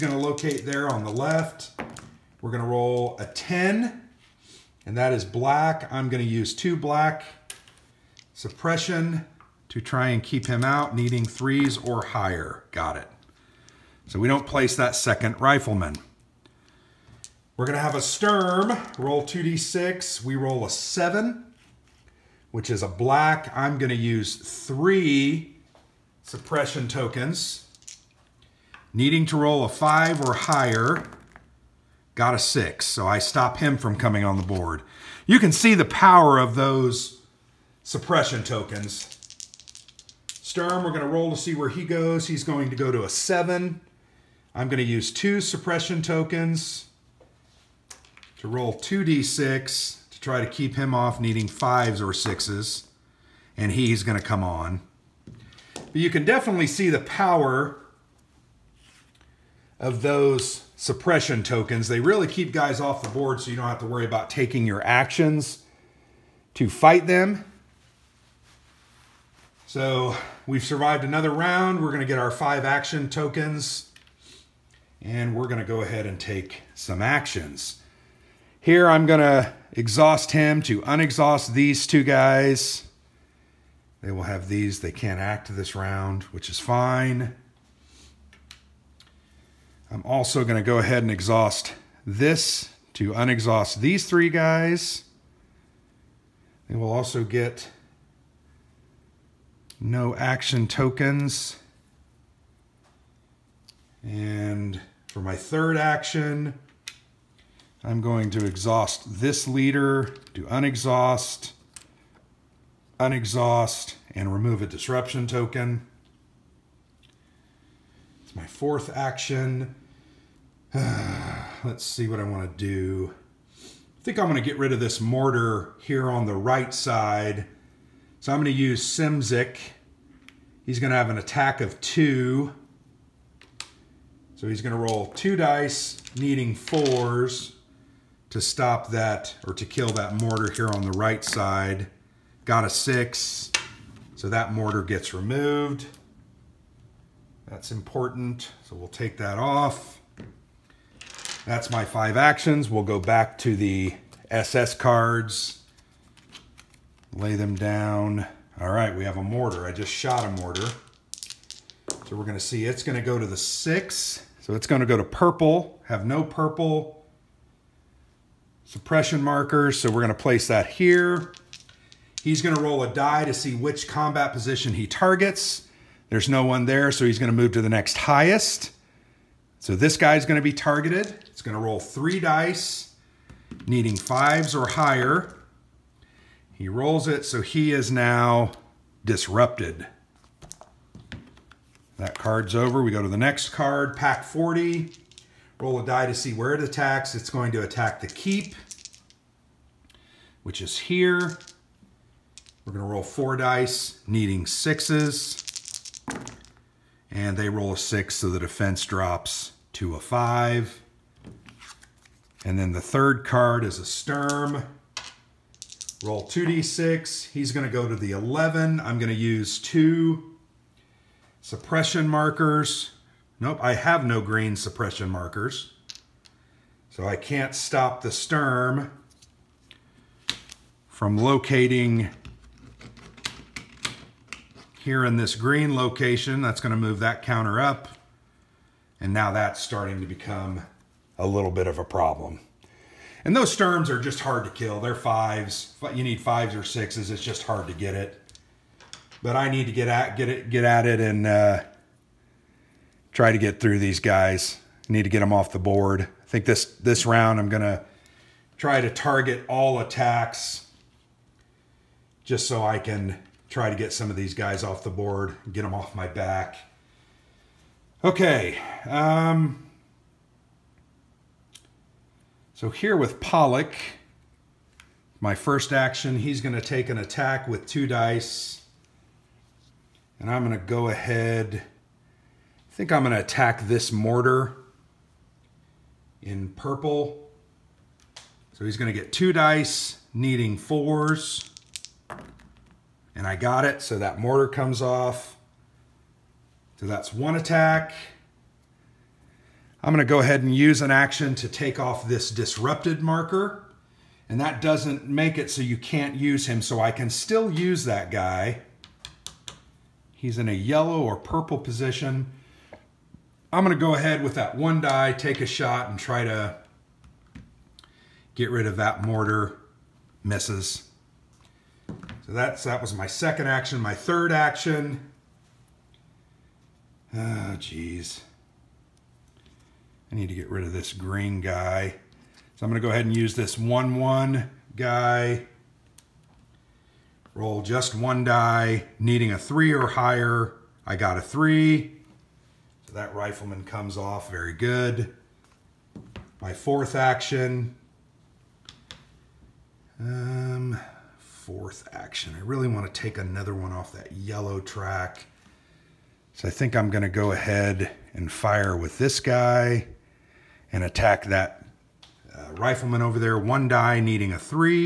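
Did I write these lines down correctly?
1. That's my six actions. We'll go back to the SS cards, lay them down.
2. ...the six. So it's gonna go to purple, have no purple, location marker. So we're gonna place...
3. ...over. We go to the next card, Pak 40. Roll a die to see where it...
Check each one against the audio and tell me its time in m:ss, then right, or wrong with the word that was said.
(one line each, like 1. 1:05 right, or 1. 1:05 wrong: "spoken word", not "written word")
1. 2:31 wrong: "five", not "six"
2. 2:43 wrong: "suppression", not "location"
3. 3:12 right.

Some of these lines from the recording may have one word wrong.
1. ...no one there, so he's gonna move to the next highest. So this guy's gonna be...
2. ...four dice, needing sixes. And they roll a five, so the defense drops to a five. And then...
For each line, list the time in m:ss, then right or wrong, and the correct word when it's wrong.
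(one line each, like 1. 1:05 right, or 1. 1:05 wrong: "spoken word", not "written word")
1. 2:56 right
2. 3:23 wrong: "six", not "five".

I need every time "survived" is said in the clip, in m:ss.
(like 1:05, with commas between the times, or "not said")
1:10.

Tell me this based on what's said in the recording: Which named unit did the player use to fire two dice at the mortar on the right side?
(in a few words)
Simzik.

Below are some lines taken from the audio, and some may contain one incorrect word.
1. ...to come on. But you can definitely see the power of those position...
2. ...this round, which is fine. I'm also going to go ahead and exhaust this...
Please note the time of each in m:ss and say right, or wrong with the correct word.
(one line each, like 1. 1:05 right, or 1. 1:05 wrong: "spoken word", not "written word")
1. 0:54 wrong: "suppression", not "position"
2. 1:25 right.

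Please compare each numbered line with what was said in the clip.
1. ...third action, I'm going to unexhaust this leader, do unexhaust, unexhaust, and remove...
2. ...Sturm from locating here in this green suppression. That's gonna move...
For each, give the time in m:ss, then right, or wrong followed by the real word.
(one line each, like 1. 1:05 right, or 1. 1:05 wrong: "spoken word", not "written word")
1. 1:45 wrong: "exhaust", not "unexhaust"
2. 3:48 wrong: "location", not "suppression".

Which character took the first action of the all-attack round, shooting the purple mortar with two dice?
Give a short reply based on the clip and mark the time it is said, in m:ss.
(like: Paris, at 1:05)
Pollock, at 4:33.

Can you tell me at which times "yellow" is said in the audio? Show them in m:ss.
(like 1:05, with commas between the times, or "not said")
5:10, 5:54.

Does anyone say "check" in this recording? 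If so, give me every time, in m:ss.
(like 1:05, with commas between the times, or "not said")
not said.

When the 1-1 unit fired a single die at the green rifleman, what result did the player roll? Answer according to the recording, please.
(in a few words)
3.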